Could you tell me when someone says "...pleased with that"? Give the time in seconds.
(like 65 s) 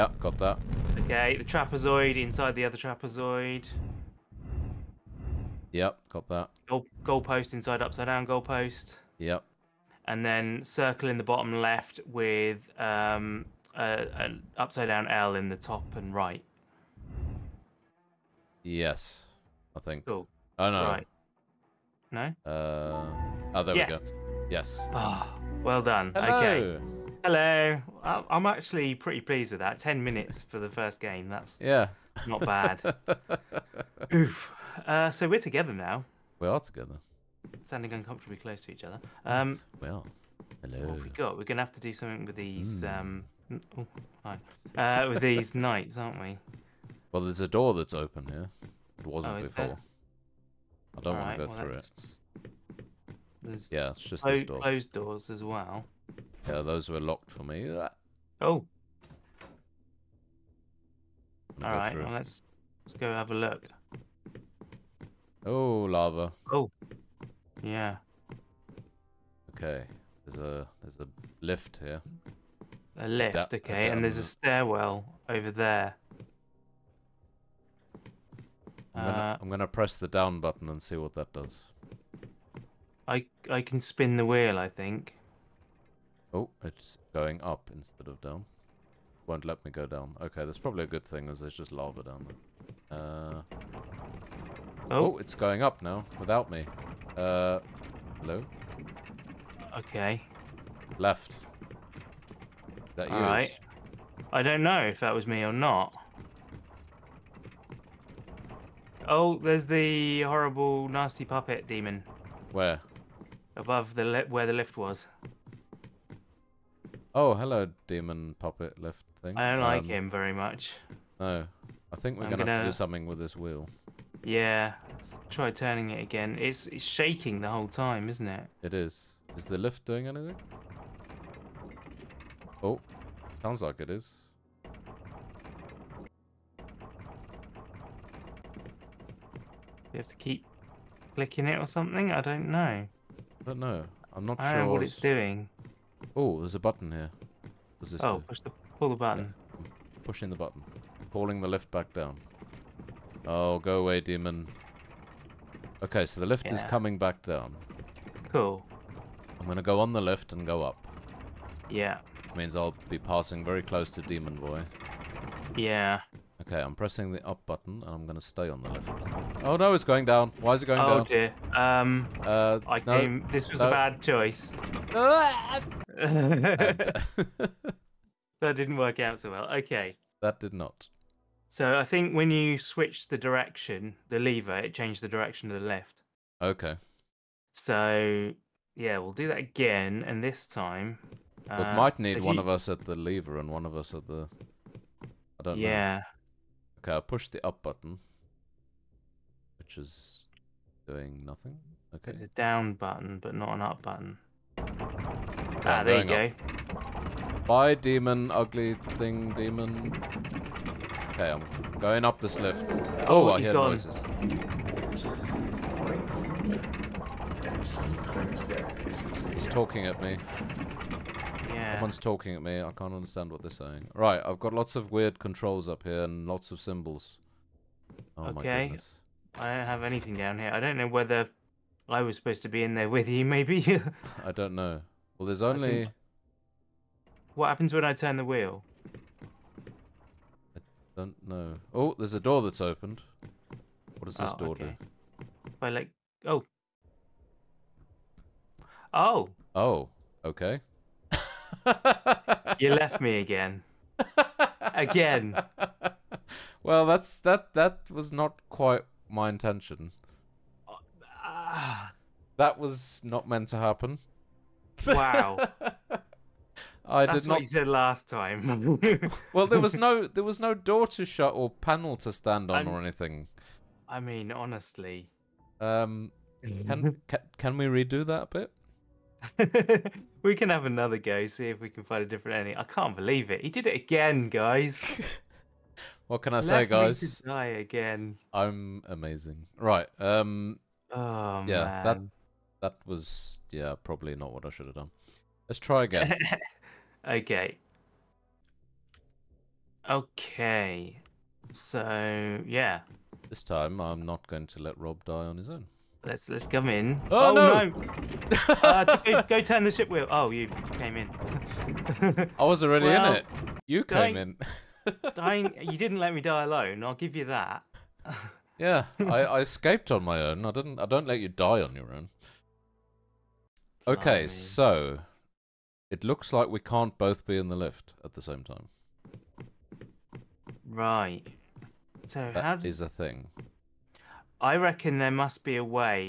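29 s.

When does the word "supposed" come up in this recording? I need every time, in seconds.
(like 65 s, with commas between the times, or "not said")
232 s.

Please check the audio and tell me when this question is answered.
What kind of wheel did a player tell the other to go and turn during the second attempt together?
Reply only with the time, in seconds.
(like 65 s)
309 s.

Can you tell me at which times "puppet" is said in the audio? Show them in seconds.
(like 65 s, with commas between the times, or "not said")
111 s, 118 s.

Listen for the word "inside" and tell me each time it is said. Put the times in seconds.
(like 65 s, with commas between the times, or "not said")
2 s, 7 s.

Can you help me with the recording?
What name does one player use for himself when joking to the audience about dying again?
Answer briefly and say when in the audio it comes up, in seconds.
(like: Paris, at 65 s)
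Rob, at 304 s.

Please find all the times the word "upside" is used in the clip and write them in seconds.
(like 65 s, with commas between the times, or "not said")
7 s, 14 s.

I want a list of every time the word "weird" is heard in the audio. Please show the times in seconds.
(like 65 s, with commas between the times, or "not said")
224 s.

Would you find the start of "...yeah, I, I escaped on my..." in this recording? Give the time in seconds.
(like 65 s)
318 s.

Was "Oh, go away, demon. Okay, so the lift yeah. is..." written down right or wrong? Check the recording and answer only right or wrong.
right.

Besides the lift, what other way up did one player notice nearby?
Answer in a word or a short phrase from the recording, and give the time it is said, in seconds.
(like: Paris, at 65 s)
stairwell, at 74 s.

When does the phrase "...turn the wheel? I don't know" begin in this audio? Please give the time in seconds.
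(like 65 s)
237 s.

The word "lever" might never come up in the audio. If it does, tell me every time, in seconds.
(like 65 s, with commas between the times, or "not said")
184 s, 192 s.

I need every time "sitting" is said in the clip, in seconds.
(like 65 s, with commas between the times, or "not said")
not said.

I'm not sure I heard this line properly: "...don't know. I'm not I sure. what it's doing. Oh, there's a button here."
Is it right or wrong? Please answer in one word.
right.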